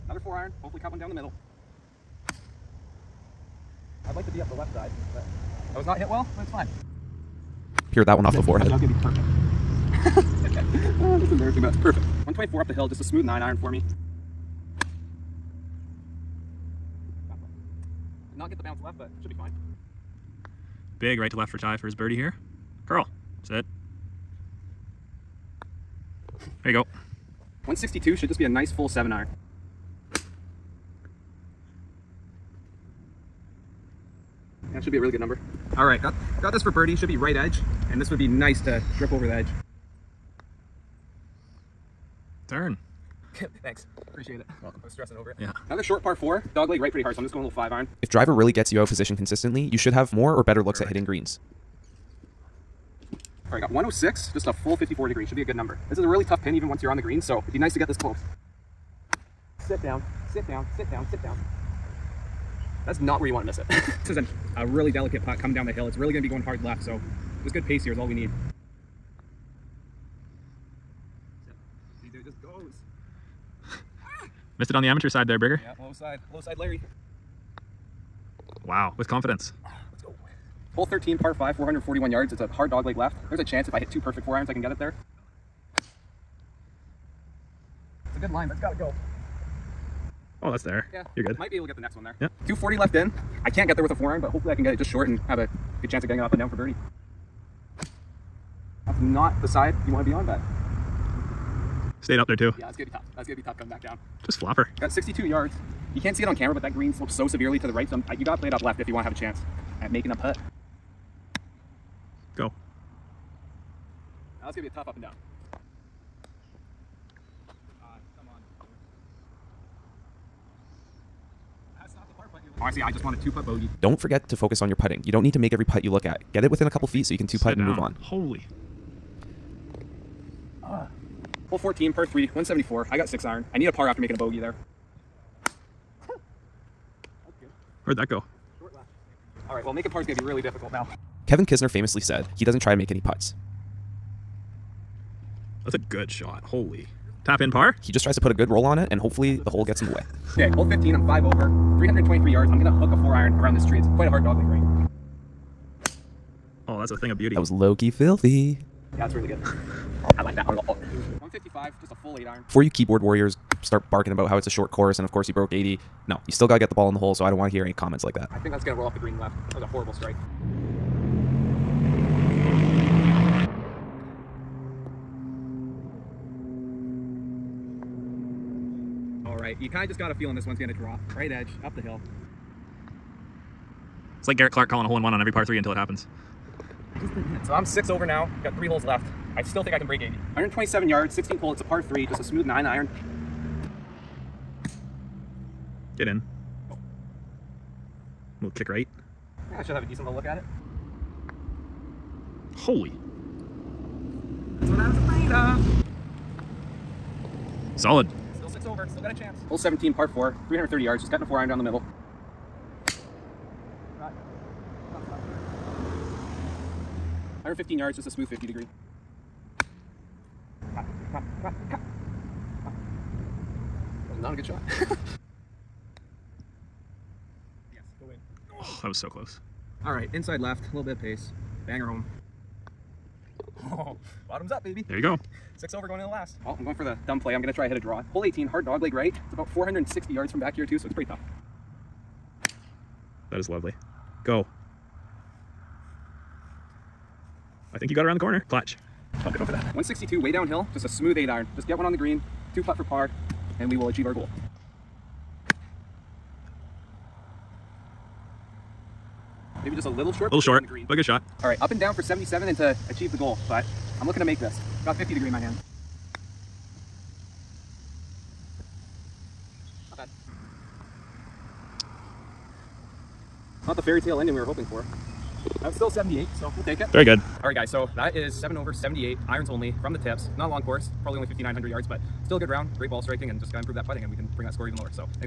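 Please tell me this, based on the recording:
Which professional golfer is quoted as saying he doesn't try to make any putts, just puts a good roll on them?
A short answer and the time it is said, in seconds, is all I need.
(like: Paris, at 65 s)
Kevin Kisner, at 141 s.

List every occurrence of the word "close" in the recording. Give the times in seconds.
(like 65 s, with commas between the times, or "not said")
57 s, 229 s.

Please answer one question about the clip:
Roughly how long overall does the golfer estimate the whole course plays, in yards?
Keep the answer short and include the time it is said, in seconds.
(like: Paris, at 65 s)
5,900 yards, at 281 s.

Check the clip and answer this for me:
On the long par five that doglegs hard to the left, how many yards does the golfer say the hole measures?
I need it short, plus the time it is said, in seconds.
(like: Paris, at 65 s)
441, at 81 s.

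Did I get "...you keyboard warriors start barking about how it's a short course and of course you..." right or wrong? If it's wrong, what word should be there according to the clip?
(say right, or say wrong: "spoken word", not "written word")
right.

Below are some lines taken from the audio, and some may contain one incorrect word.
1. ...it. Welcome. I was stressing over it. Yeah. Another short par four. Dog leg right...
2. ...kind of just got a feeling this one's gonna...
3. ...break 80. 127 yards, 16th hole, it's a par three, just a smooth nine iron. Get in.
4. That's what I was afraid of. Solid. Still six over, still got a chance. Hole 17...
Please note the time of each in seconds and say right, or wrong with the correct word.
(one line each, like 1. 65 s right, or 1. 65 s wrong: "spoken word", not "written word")
1. 44 s right
2. 179 s right
3. 189 s right
4. 204 s right.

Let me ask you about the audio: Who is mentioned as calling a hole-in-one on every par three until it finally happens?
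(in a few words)
Garrett Clark.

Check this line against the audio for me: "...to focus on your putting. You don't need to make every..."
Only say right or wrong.
right.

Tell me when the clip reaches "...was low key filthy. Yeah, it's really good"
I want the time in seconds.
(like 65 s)
157 s.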